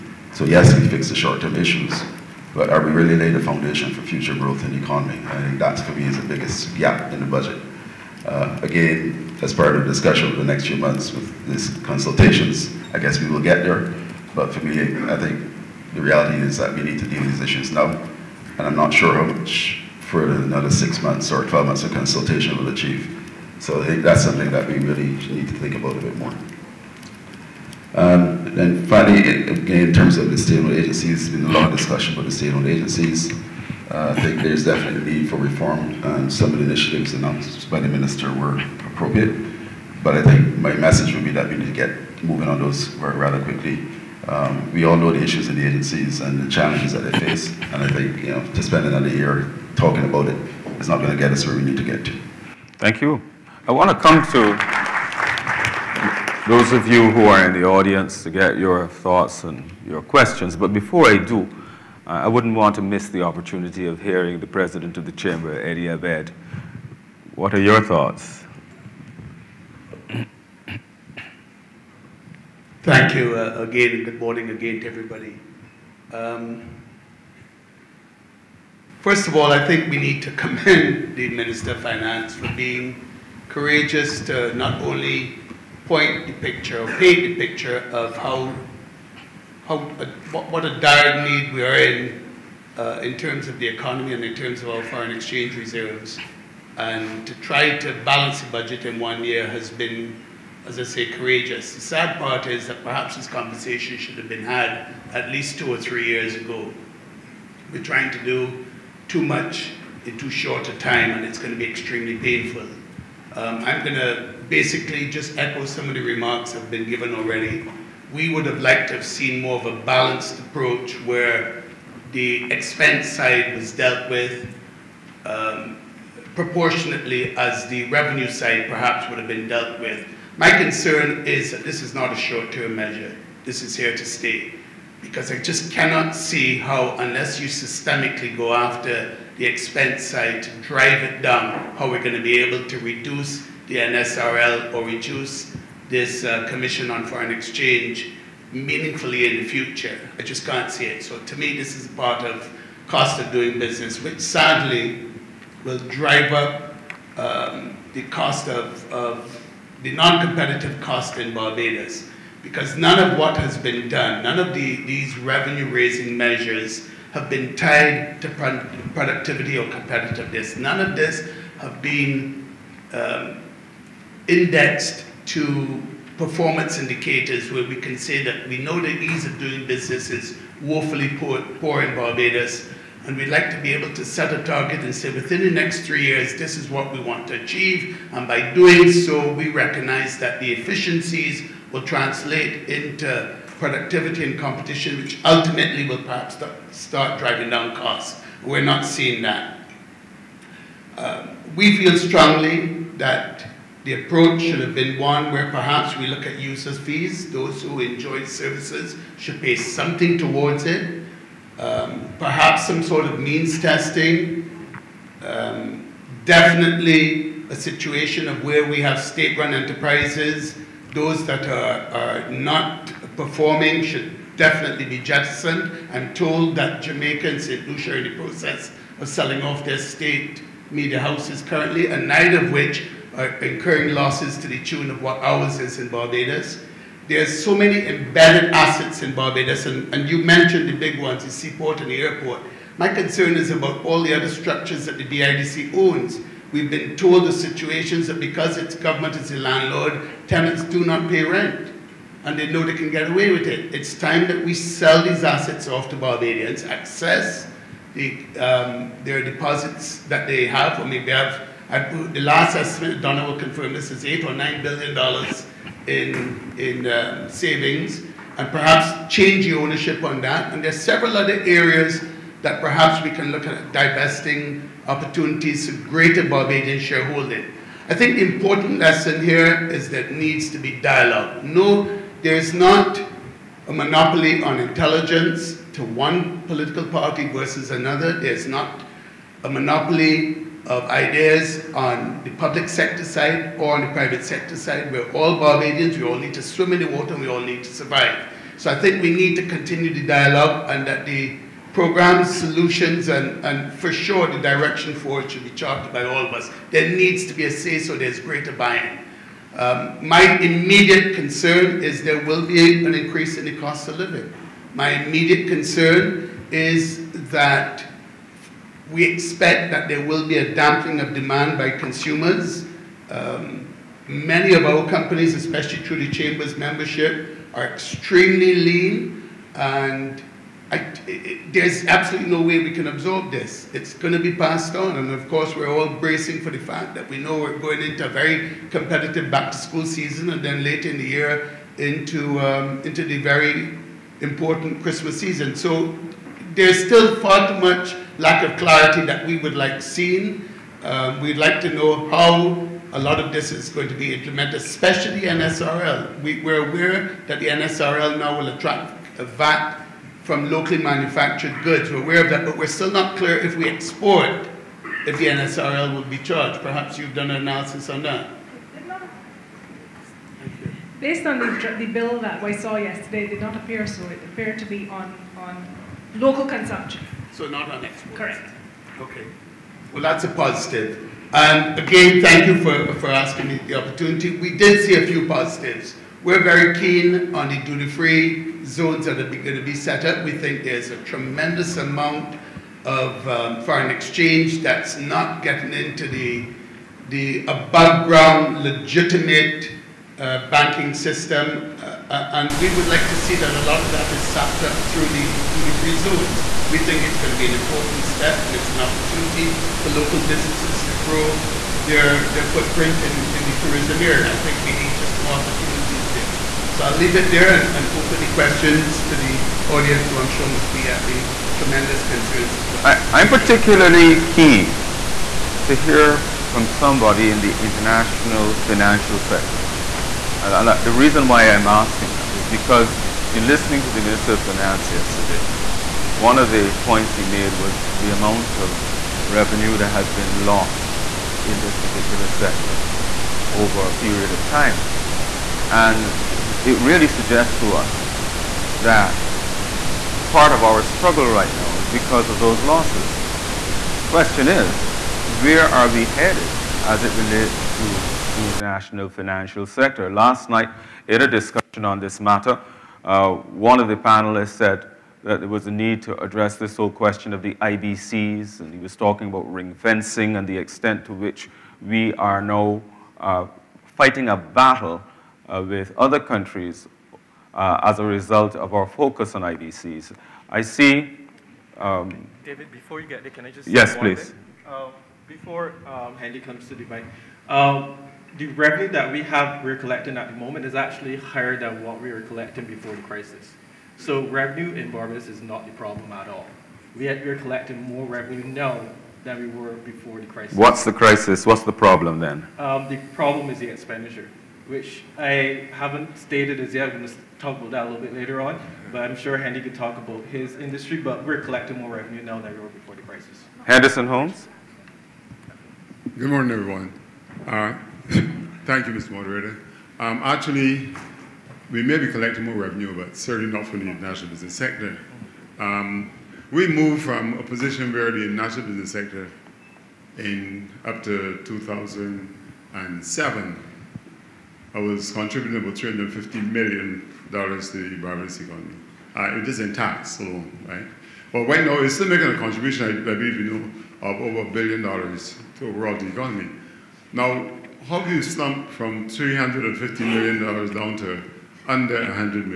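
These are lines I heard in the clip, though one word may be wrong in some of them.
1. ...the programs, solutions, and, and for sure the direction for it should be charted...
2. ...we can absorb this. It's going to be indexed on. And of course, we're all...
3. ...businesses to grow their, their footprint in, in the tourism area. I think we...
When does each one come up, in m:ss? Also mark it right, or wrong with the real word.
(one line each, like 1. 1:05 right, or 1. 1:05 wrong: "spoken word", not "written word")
1. 5:01 right
2. 5:32 wrong: "passed", not "indexed"
3. 6:50 right.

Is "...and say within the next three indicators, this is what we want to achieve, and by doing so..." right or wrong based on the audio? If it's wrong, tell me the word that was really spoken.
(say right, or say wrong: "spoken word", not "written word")
wrong: "years", not "indicators".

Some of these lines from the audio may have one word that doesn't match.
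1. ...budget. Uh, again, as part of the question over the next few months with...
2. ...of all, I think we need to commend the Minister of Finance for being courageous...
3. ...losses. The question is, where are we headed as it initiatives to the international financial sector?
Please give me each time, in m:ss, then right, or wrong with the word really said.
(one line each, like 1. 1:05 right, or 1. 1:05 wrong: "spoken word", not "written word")
1. 0:07 wrong: "discussion", not "question"
2. 1:19 right
3. 7:32 wrong: "relates", not "initiatives".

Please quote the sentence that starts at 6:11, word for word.
Based on the, the bill that we saw yesterday, it did not appear so.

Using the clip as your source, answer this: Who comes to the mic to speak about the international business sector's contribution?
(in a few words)
Henderson Holmes.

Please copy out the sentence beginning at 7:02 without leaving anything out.
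I, I'm particularly keen to hear from somebody in the international financial sector.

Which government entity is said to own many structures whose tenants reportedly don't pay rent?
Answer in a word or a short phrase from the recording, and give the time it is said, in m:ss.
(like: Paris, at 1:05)
DIDC, at 4:05.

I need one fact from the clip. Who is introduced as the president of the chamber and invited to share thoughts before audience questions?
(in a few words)
Eddie Abed.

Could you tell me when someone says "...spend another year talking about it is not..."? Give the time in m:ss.
0:48.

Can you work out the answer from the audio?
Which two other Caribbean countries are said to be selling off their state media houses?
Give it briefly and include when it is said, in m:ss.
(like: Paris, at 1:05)
Jamaica and St. Lucia, at 3:46.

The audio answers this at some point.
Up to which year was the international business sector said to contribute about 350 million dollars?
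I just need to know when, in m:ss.
8:51.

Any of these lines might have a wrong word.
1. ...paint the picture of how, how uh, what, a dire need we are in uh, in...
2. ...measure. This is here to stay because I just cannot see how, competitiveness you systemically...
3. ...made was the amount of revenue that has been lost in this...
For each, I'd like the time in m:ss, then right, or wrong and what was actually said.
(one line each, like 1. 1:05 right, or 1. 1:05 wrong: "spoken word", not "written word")
1. 1:26 right
2. 2:12 wrong: "unless", not "competitiveness"
3. 7:17 right.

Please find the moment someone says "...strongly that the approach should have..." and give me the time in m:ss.
3:21.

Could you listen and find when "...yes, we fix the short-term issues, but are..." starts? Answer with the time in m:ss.
0:00.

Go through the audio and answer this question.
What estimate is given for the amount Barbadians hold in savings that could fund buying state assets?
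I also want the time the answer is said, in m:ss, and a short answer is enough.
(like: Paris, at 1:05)
8 or 9 billion dollars, at 4:24.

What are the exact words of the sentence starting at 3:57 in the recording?
There's so many embedded assets in Barbados, and, and you mentioned the big ones, the seaport and the airport.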